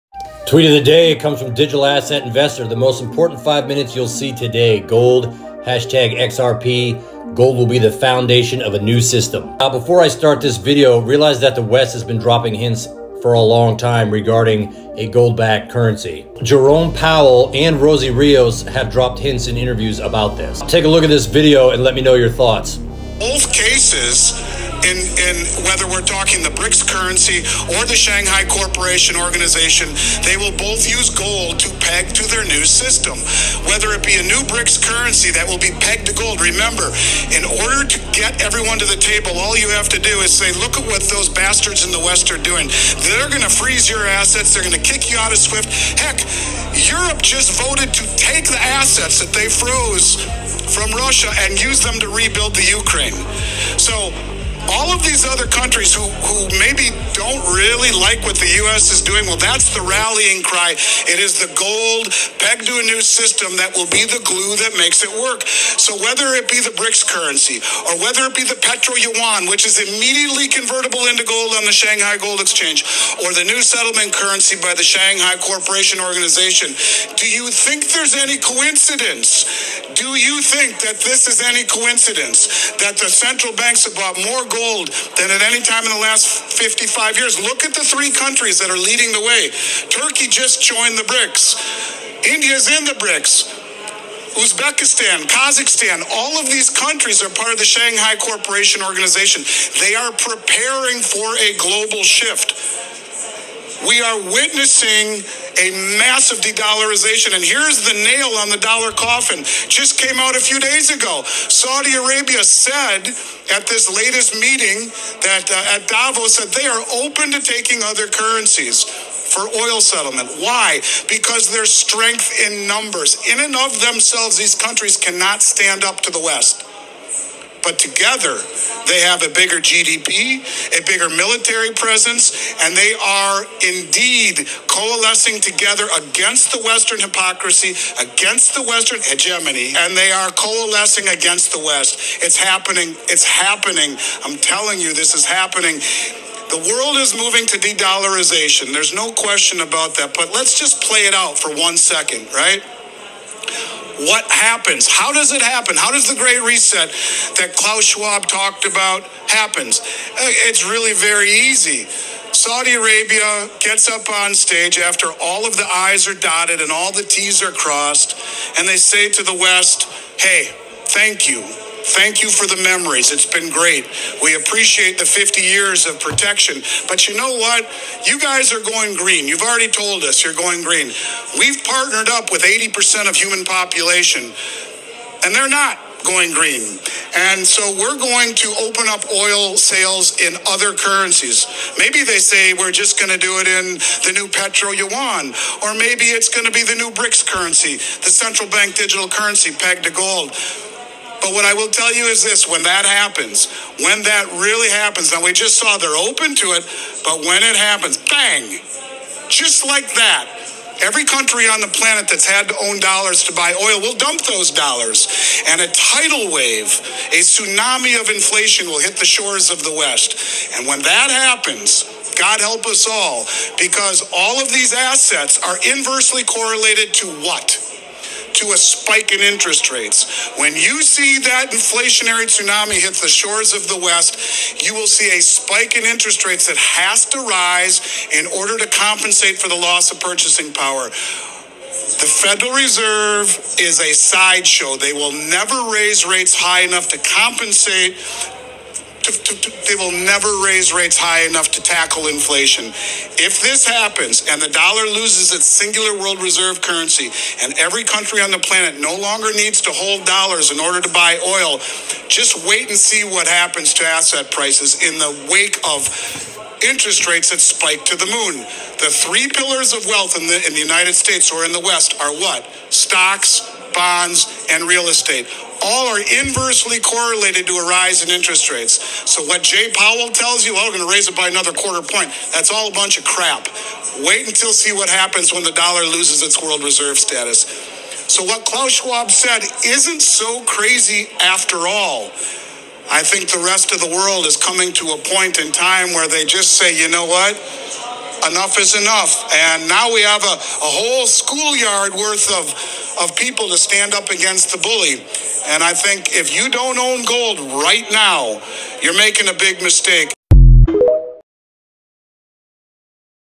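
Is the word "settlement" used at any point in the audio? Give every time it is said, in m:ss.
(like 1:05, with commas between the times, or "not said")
1:13, 1:59.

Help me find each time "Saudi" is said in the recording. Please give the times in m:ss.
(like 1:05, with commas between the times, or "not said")
1:51, 2:42.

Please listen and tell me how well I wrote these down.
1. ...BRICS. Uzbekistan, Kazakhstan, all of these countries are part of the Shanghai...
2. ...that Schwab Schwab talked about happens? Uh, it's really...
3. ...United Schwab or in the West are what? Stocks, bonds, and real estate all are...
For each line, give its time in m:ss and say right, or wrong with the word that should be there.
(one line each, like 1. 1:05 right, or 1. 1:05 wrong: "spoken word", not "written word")
1. 1:33 right
2. 2:37 wrong: "Klaus", not "Schwab"
3. 4:30 wrong: "States", not "Schwab".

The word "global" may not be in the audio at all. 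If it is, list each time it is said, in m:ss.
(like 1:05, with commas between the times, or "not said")
1:41.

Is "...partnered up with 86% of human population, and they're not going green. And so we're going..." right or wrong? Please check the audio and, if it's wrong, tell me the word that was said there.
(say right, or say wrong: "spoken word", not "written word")
wrong: "80", not "86".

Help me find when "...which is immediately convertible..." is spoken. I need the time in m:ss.
1:09.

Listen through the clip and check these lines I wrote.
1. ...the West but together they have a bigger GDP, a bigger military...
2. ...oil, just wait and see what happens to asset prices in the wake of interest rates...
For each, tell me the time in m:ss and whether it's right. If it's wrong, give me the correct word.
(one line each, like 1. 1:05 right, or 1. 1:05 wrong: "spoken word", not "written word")
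1. 2:06 right
2. 4:21 right.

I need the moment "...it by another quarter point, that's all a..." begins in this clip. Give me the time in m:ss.
4:41.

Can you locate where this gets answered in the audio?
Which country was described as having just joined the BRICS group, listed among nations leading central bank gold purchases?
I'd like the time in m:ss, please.
1:29.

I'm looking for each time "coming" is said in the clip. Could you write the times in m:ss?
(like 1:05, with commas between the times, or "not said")
4:54.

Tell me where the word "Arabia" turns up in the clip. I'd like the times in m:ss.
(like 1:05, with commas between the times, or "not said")
1:51, 2:42.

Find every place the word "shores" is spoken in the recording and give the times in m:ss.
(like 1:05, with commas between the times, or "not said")
3:39, 3:53.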